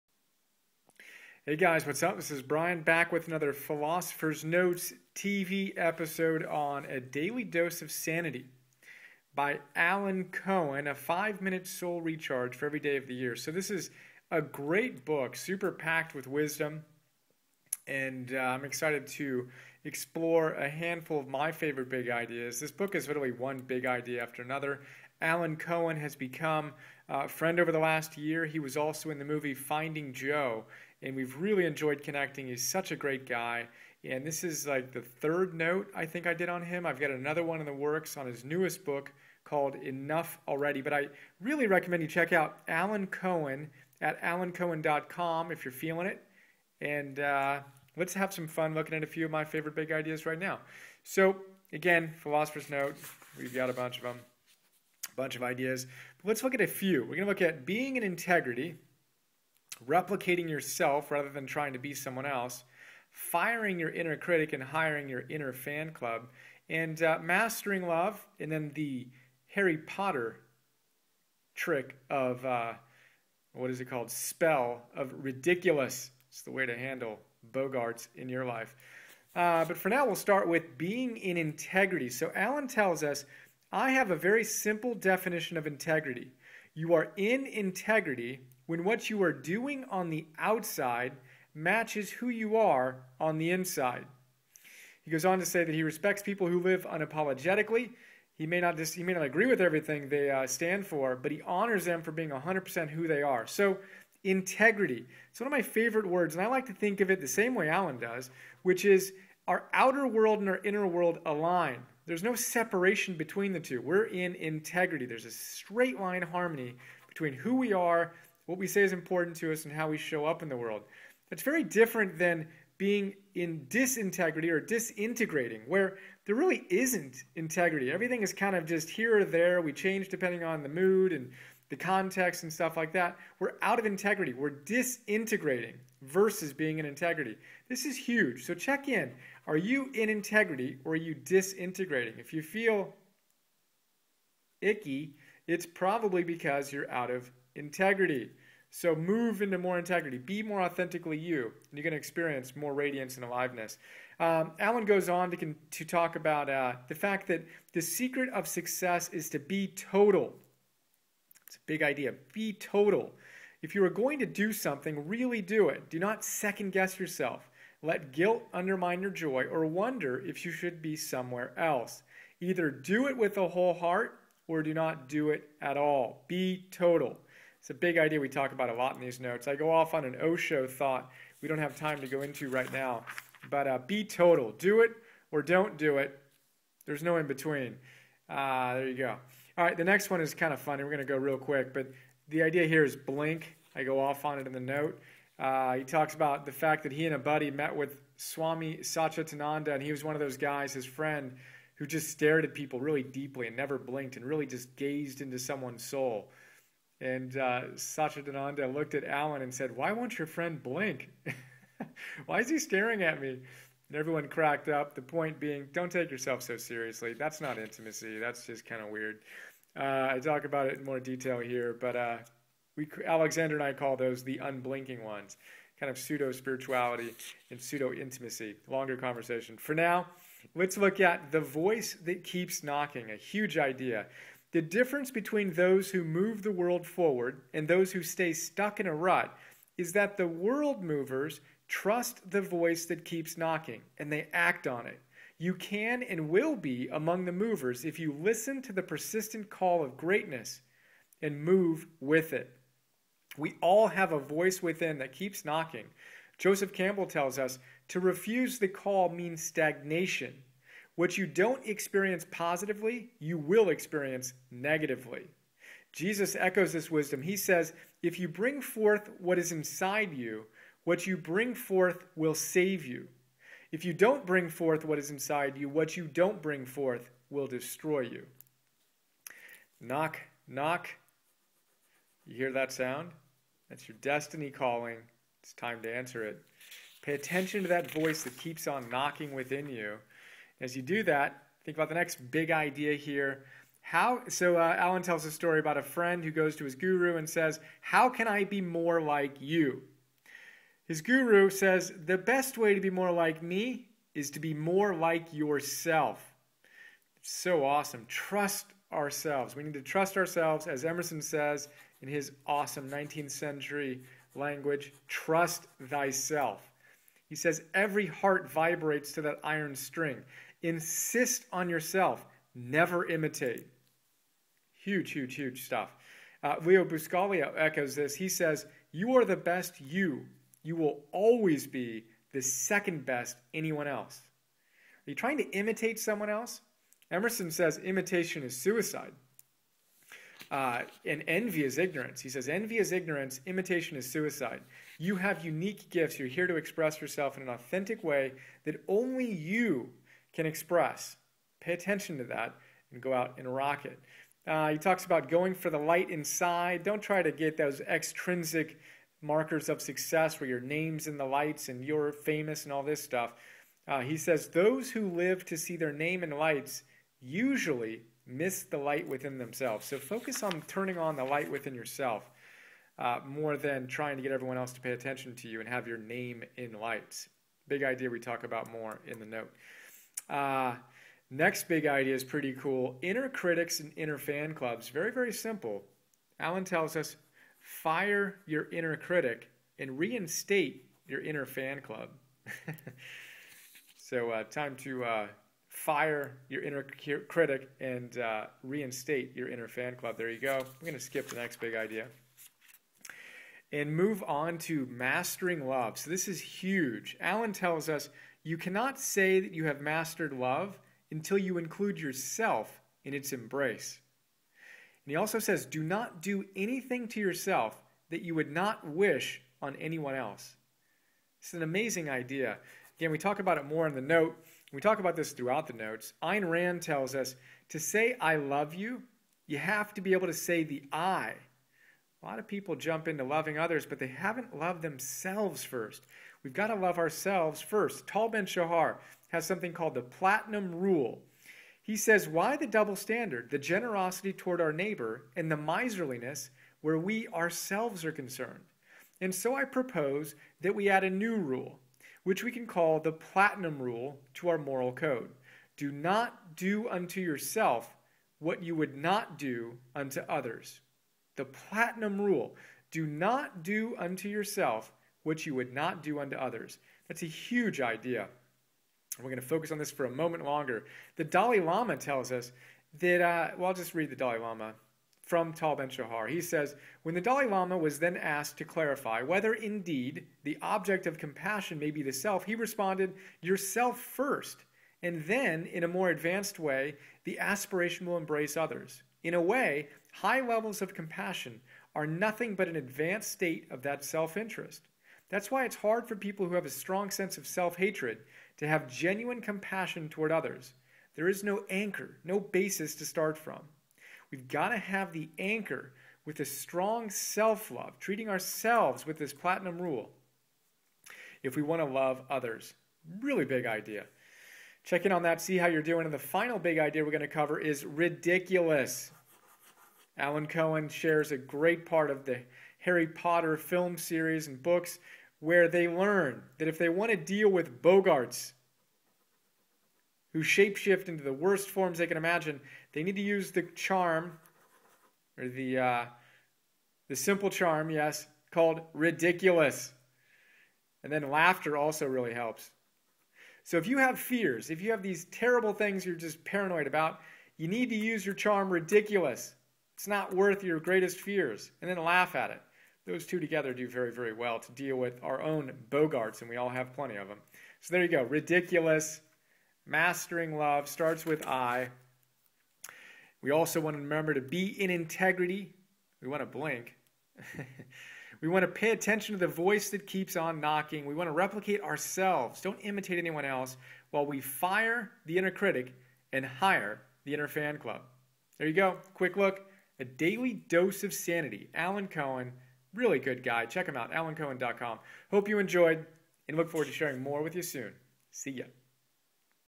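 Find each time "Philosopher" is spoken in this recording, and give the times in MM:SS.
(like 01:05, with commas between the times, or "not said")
00:03, 00:52.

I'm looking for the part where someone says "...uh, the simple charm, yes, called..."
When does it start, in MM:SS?
08:55.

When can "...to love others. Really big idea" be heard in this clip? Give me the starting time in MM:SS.
08:31.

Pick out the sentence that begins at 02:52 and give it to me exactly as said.
Either do it with a whole heart or do not do it at all.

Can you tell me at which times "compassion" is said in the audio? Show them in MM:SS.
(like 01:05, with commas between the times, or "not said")
08:01, 08:10, 08:19.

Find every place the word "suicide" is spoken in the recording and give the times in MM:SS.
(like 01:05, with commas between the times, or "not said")
05:38, 05:44.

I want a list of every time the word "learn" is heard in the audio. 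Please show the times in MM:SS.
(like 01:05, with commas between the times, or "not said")
08:45.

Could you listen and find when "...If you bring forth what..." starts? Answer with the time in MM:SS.
04:28.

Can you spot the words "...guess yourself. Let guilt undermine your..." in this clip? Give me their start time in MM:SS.
02:46.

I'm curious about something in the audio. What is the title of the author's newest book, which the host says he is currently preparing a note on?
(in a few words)
Enough Already.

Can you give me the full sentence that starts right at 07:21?
He says, Why the double standard, the generosity toward our neighbor, and the miserliness where we ourselves are concerned?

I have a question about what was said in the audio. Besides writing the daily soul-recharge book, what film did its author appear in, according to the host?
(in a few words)
Finding Joe.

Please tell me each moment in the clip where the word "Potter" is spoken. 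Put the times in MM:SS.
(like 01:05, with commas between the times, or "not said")
01:09, 08:43.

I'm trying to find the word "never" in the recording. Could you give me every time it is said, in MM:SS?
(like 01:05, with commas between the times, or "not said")
03:23, 05:22.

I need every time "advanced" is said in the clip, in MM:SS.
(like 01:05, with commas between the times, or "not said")
08:06, 08:12.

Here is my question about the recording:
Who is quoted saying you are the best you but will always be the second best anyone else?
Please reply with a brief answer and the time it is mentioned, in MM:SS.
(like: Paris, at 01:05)
Leo Buscaglia, at 05:26.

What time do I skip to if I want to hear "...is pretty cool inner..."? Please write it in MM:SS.
06:22.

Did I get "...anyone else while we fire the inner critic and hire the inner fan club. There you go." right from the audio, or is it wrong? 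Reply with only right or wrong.
right.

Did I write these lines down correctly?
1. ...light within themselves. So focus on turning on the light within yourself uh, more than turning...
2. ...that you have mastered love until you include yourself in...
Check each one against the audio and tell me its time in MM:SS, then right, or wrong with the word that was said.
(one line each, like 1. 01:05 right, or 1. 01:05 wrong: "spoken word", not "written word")
1. 06:08 wrong: "trying", not "turning"
2. 06:49 right.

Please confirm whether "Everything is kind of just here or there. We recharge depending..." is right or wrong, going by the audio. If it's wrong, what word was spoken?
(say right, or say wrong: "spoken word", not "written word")
wrong: "change", not "recharge".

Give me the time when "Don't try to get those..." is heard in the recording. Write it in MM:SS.
05:56.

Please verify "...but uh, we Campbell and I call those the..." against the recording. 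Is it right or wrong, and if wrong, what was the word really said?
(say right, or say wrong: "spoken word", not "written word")
wrong: "Alexander", not "Campbell".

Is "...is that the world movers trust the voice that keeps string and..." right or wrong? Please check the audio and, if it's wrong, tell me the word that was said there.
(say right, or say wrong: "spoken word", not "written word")
wrong: "knocking", not "string".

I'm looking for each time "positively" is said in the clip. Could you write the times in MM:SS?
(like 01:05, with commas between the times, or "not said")
04:22.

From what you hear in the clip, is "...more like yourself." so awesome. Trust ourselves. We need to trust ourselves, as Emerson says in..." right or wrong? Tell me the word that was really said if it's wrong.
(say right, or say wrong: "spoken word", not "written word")
right.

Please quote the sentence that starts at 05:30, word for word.
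You will always be the second best anyone else.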